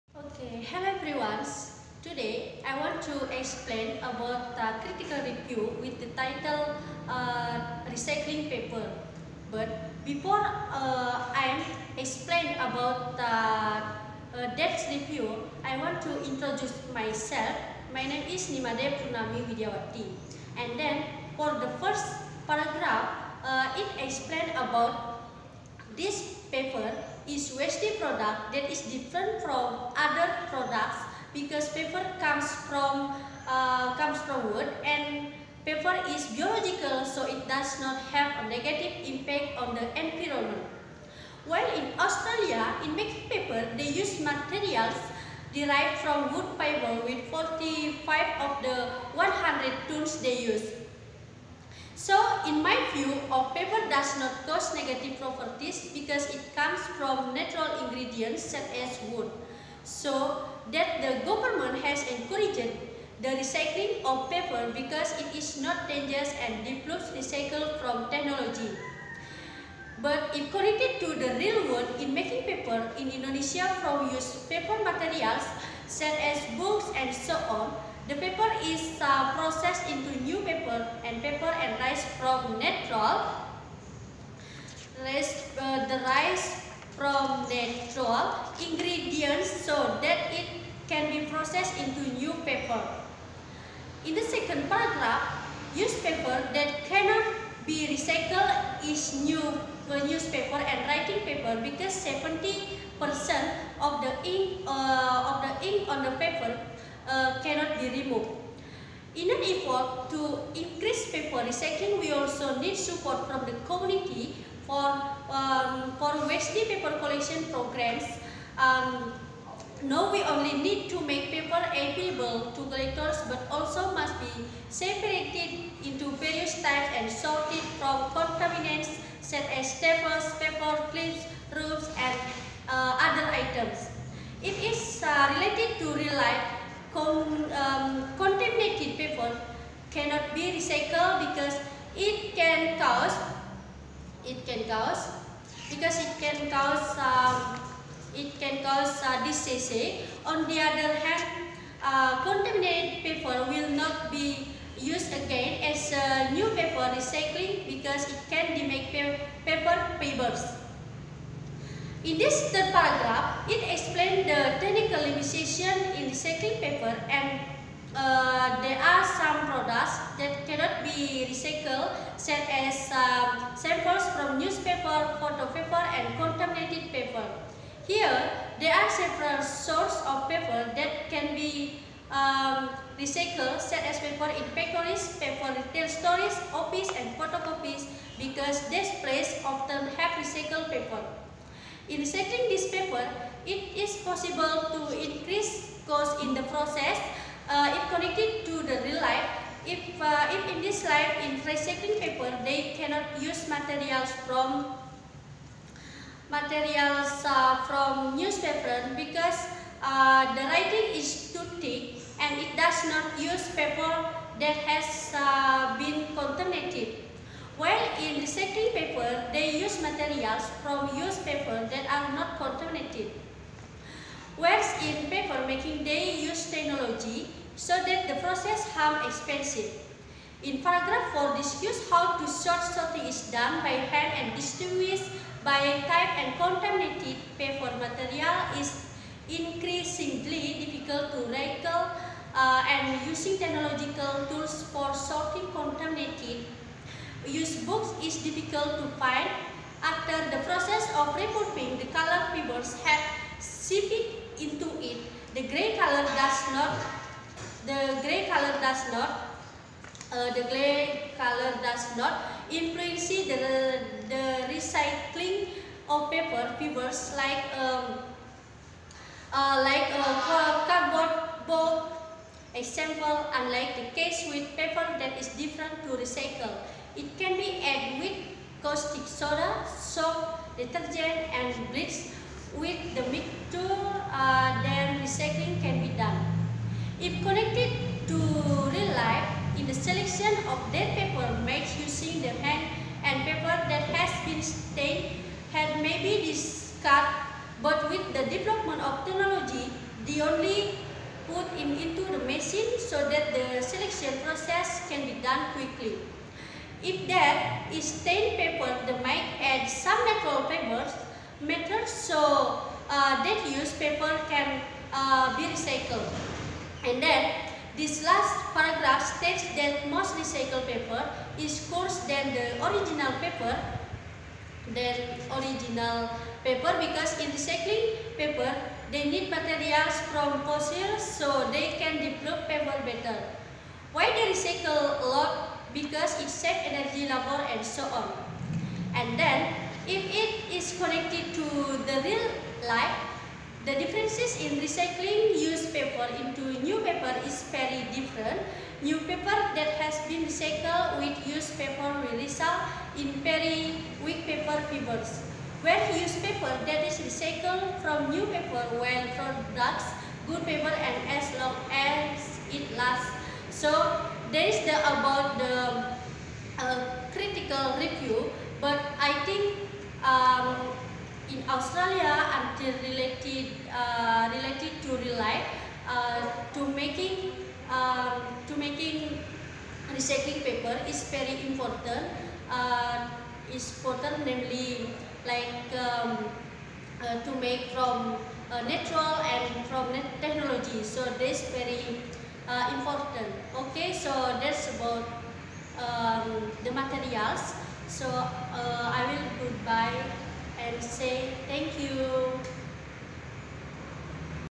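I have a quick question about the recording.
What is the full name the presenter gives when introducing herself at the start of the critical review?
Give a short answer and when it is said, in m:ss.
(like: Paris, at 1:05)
Ni Made Purnami Widyawati, at 0:18.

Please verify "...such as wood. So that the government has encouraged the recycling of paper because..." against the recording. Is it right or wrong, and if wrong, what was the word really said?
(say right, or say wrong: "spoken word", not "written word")
right.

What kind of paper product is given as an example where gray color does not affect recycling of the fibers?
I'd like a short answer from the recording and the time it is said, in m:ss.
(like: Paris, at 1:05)
cardboard box, at 4:30.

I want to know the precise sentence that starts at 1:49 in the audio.
In an effort to increase paper recycling, we also need support from the community for um, for waste paper collection programs.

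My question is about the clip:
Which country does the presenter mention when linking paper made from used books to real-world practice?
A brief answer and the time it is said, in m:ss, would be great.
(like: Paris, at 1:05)
Indonesia, at 1:13.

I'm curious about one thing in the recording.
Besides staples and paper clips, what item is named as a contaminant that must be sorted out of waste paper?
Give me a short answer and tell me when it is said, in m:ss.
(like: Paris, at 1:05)
ropes, at 2:11.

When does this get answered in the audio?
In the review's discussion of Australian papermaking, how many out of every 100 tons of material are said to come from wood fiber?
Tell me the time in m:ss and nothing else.
0:47.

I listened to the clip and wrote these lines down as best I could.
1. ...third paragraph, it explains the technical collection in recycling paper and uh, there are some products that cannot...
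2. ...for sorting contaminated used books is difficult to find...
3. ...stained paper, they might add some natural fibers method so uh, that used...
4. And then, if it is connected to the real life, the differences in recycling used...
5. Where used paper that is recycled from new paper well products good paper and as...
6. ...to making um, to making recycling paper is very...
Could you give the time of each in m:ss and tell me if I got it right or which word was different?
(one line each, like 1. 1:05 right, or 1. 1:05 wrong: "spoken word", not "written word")
1. 2:42 wrong: "limitation", not "collection"
2. 4:04 right
3. 5:07 right
4. 5:38 right
5. 5:55 right
6. 6:16 right.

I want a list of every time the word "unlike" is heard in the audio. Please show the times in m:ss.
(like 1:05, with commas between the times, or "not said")
4:33.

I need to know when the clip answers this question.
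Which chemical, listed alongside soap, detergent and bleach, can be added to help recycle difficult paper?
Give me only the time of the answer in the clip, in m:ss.
4:38.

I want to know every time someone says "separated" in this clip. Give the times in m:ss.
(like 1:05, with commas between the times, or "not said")
2:04.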